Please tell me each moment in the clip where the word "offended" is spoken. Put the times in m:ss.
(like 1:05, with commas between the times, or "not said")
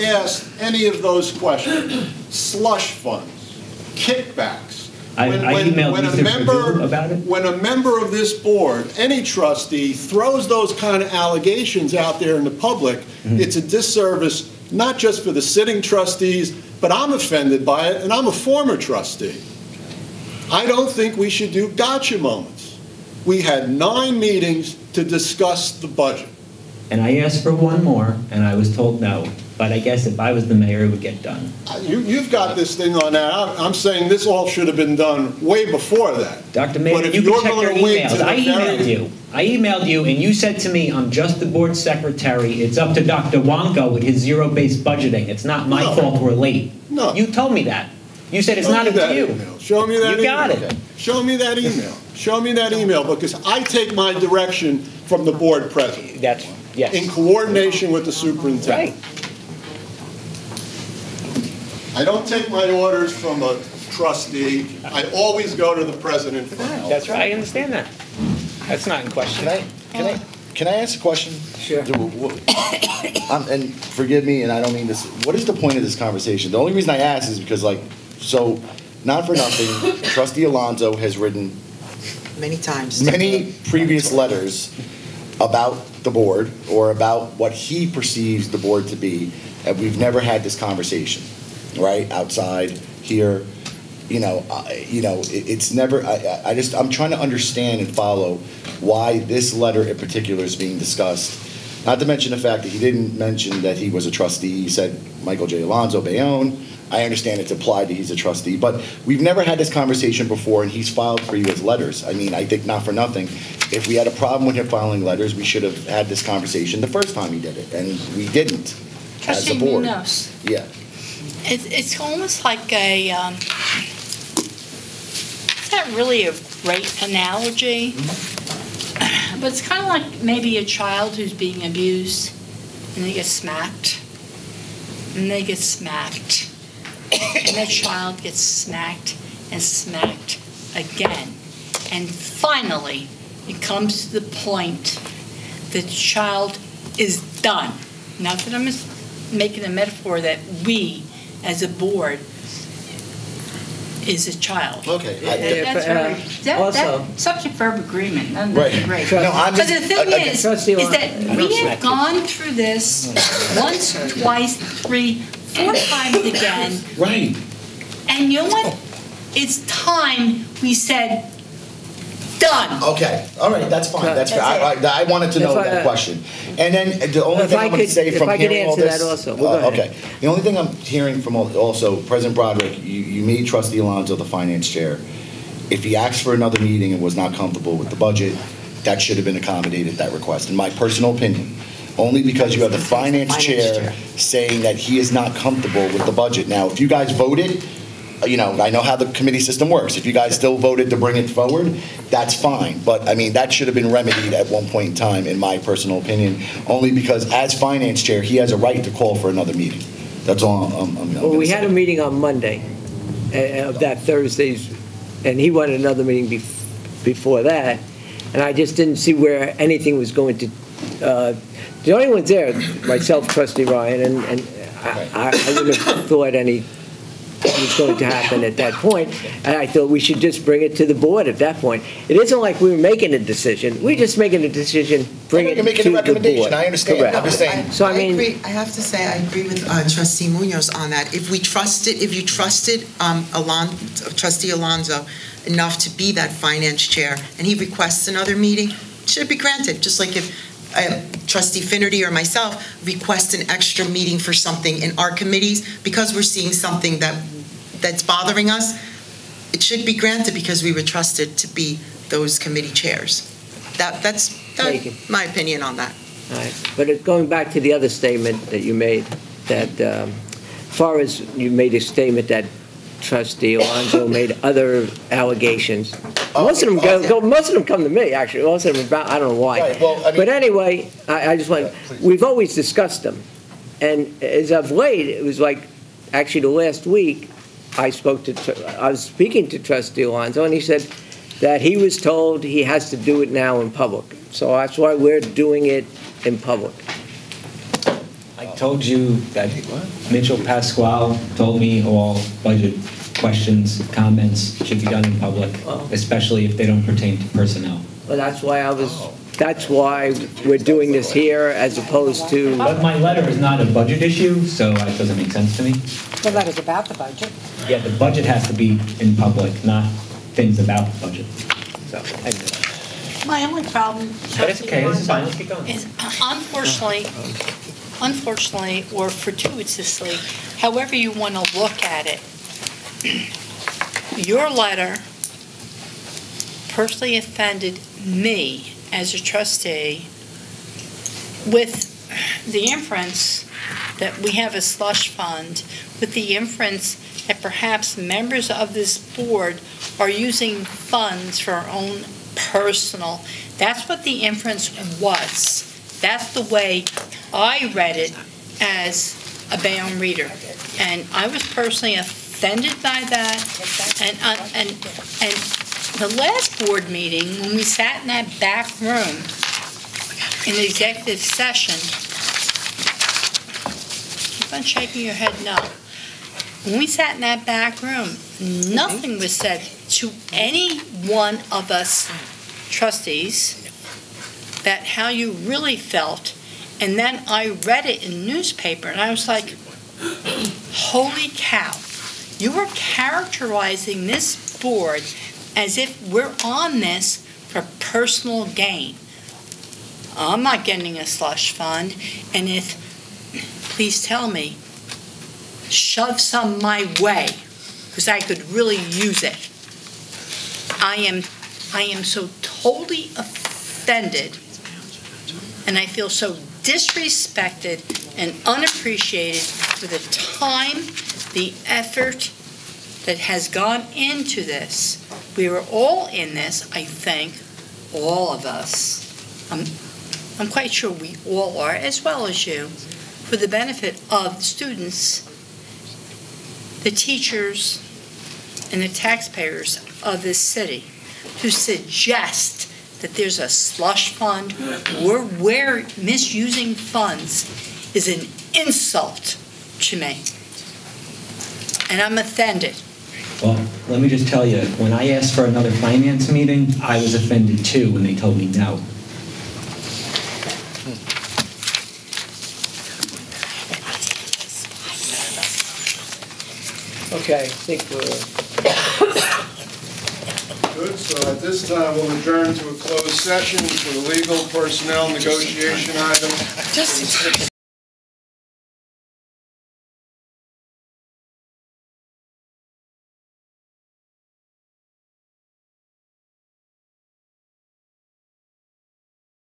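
0:17, 5:37, 6:01, 6:53, 7:32, 7:37.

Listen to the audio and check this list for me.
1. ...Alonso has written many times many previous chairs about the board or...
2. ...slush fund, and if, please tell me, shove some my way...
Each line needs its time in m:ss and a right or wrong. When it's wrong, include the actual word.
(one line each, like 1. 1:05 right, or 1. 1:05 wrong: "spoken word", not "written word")
1. 1:20 wrong: "letters", not "chairs"
2. 6:41 right.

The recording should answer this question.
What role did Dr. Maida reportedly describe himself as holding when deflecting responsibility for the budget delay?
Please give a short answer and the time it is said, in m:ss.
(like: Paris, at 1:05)
board secretary, at 0:41.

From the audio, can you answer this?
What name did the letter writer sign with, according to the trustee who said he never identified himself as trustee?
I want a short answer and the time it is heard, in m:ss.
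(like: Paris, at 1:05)
Michael J. Alonzo Bayonne, at 1:45.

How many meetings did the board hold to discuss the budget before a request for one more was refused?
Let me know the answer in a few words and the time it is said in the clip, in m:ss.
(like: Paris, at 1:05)
9, at 0:23.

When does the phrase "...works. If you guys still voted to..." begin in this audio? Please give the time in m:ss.
3:19.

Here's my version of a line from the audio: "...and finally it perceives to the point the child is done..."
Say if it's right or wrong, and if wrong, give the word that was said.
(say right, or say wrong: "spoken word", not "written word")
wrong: "comes", not "perceives".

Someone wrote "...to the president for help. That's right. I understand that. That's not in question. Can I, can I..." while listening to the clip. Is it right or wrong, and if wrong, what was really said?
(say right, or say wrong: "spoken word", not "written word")
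right.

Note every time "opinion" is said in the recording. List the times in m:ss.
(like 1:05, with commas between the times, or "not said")
3:11, 3:26, 4:25.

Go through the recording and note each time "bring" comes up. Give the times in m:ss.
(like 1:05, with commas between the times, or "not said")
3:20, 3:50, 3:55.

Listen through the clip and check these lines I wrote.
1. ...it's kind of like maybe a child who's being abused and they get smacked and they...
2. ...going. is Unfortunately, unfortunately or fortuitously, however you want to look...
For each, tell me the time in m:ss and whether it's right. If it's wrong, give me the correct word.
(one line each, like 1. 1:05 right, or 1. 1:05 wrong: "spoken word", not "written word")
1. 2:09 right
2. 5:25 right.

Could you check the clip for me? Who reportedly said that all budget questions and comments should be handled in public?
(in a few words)
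Mitchell Pasquale.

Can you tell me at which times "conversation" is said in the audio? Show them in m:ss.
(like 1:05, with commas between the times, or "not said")
1:15, 1:30, 1:49, 1:56.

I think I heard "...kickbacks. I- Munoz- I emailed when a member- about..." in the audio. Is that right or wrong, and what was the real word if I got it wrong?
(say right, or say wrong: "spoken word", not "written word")
wrong: "When", not "Munoz".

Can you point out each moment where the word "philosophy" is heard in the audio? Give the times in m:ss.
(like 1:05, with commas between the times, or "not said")
not said.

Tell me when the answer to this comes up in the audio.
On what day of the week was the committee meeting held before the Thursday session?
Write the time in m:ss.
3:32.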